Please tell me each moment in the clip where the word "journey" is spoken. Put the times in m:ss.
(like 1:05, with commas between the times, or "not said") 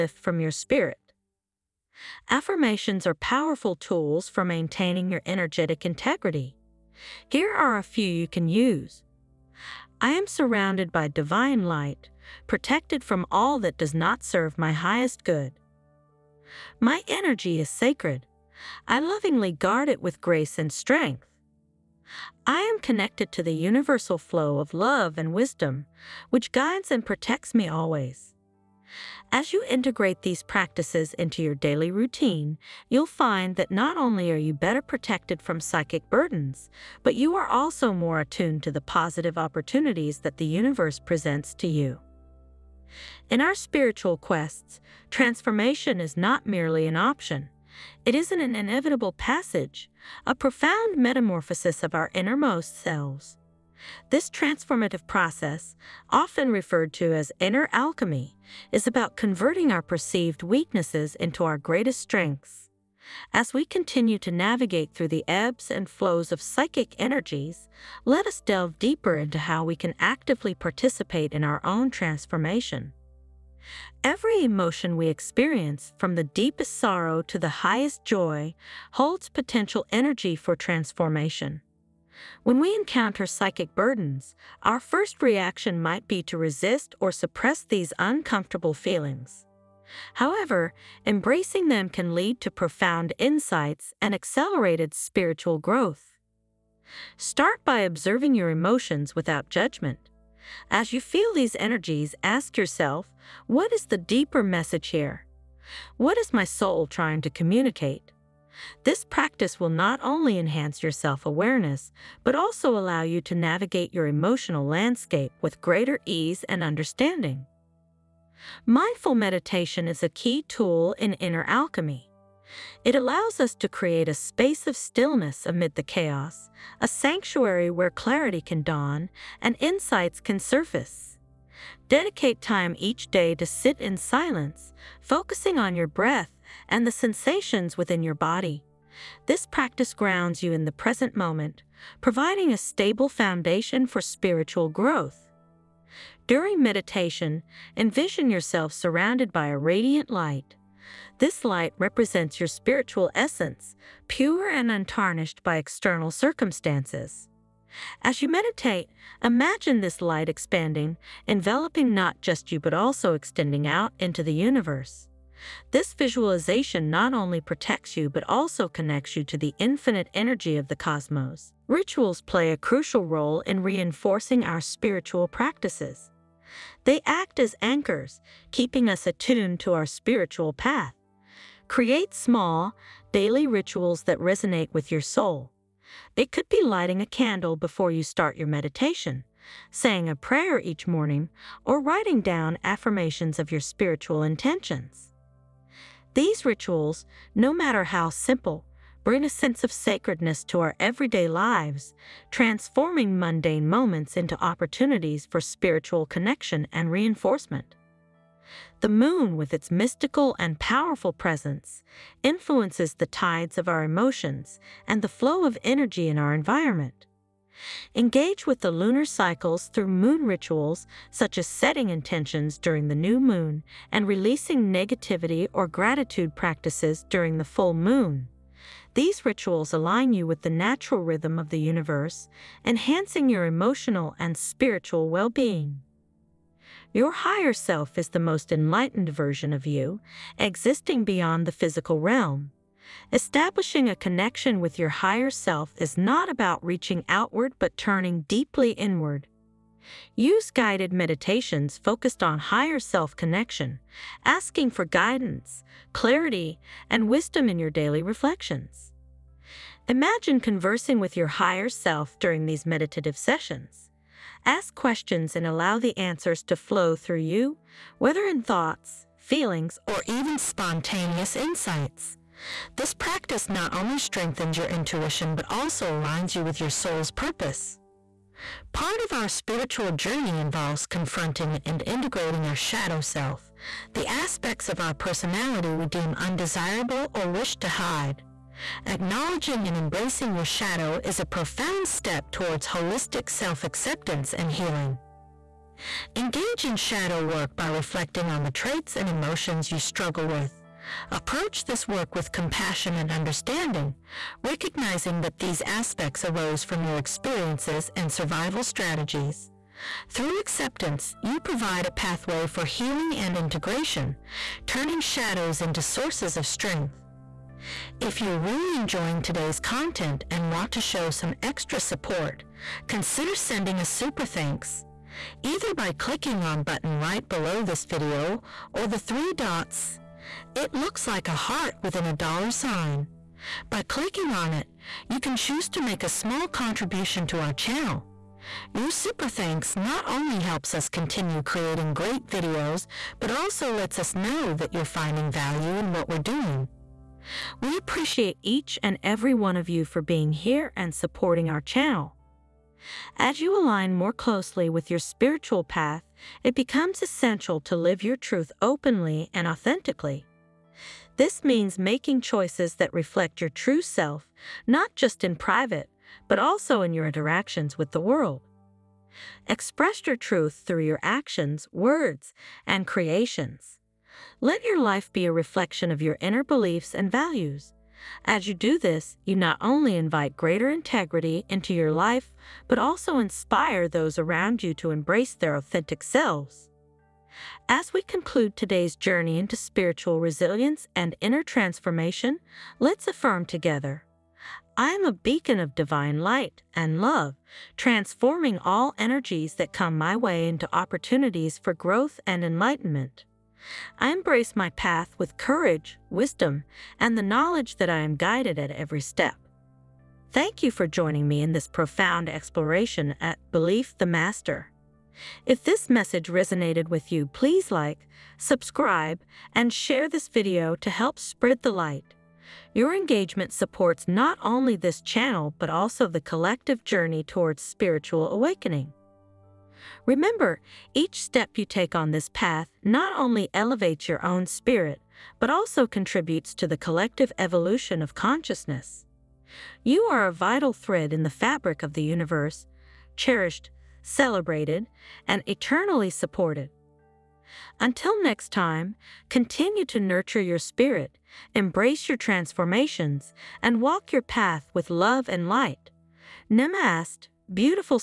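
4:39, 6:28, 7:06.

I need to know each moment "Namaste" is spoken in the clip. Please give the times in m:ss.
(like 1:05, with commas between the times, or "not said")
7:36.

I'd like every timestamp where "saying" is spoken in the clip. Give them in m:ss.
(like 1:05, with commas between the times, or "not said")
3:09.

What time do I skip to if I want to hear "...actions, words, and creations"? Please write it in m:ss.
6:11.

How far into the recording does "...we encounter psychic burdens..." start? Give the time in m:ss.
1:22.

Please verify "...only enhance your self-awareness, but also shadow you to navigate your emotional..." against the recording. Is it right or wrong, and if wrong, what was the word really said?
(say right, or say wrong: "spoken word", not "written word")
wrong: "allow", not "shadow".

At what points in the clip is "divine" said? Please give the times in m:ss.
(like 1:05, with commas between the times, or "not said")
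0:11, 6:35.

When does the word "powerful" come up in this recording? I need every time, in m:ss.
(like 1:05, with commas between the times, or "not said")
0:03, 3:30.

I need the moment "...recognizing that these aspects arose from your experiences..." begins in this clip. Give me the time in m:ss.
5:04.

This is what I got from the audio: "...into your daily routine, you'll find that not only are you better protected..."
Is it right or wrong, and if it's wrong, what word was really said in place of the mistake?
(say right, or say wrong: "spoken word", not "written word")
right.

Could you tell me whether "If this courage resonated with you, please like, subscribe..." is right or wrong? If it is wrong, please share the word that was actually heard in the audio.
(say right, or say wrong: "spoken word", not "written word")
wrong: "message", not "courage".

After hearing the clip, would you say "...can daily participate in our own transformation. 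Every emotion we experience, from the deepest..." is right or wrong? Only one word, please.
wrong.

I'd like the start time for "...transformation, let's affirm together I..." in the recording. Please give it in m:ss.
6:31.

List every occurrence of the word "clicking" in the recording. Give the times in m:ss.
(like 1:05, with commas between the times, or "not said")
5:25, 5:33.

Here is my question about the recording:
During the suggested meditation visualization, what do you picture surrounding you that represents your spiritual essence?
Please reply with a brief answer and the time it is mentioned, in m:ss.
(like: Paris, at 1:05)
A radiant light, at 2:29.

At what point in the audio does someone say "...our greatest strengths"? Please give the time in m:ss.
1:01.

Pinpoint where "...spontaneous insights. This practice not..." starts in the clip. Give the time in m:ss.
4:30.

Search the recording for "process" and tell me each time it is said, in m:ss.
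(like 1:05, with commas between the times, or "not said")
0:55.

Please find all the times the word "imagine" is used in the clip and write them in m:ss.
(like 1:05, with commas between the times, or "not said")
2:39, 4:19.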